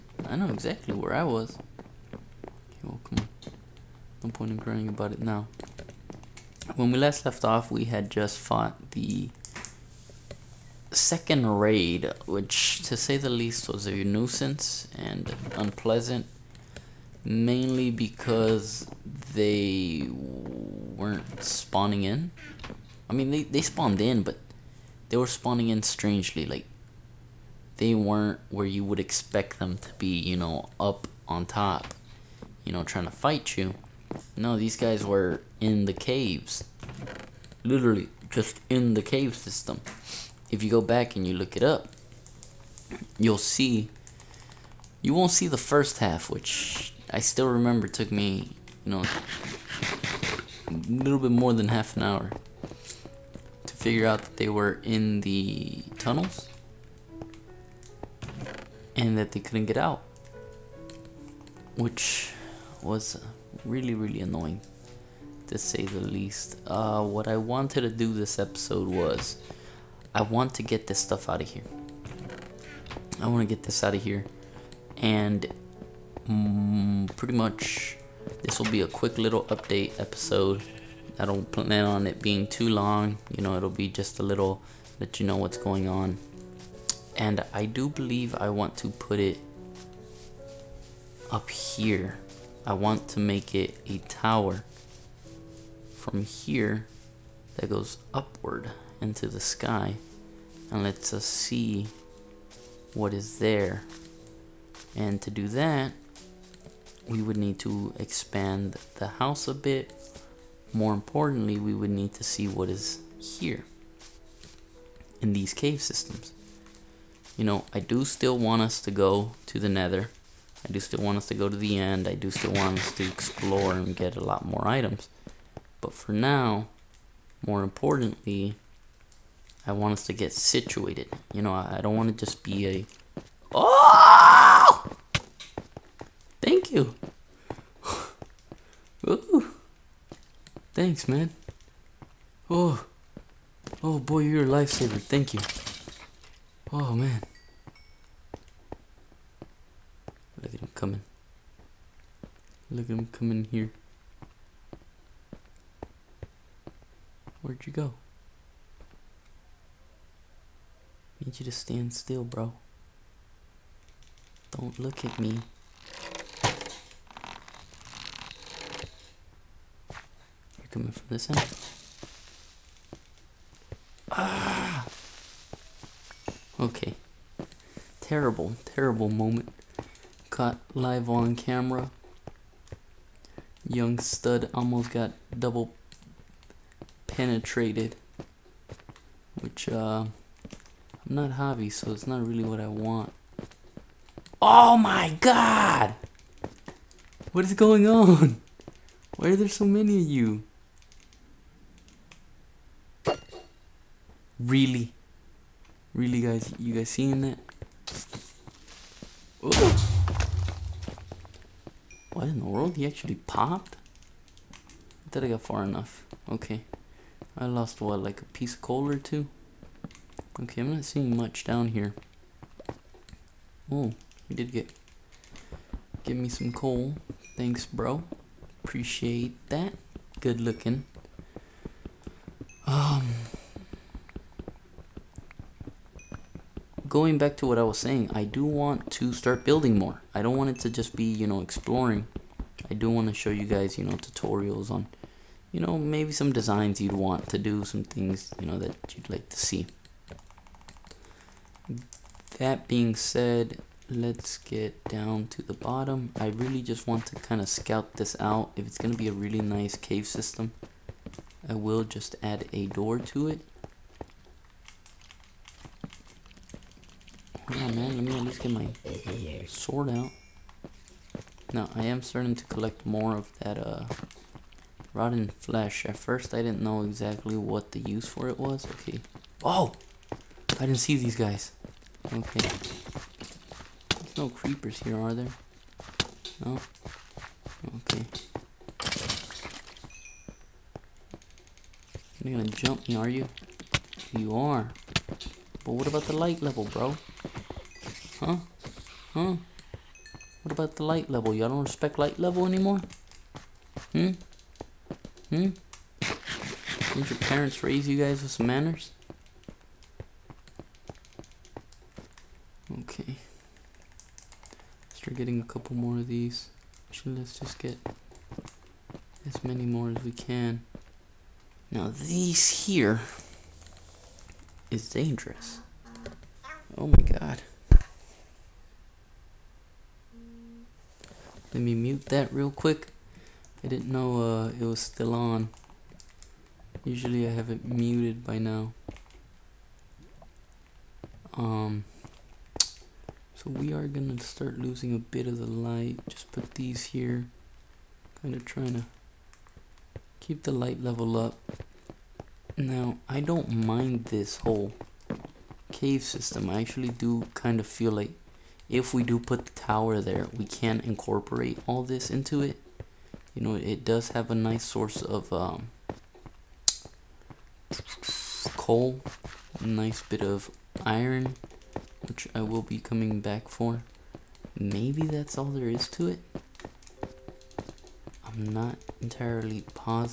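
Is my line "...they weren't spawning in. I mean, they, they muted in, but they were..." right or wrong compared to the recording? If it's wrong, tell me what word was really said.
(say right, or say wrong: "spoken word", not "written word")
wrong: "spawned", not "muted".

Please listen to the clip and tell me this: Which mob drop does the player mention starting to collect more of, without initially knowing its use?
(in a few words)
Rotten flesh.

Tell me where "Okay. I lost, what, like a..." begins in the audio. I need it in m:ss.
3:36.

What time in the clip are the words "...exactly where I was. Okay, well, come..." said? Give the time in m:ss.
0:00.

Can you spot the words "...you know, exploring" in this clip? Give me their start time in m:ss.
4:01.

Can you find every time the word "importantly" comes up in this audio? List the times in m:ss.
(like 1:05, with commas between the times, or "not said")
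1:50, 2:07.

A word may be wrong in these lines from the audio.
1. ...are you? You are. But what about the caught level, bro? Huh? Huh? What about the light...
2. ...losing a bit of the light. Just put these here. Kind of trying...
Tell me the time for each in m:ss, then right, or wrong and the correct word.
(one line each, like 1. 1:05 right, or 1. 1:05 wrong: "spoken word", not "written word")
1. 4:52 wrong: "light", not "caught"
2. 5:44 right.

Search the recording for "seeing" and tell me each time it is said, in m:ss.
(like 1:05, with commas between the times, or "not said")
3:26, 3:40.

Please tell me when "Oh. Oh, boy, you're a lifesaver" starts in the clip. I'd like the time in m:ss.
2:22.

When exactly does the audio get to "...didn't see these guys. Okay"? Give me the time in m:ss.
4:40.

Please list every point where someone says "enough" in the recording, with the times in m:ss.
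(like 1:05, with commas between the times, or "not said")
3:35.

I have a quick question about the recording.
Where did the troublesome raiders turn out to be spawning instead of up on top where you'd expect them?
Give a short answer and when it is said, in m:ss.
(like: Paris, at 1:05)
In the caves, at 0:35.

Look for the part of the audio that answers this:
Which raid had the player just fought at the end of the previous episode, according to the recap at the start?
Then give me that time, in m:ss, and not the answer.
0:10.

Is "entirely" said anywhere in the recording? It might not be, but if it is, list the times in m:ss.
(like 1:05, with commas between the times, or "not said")
6:18.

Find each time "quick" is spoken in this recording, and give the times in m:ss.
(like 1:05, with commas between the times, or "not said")
1:18, 5:32.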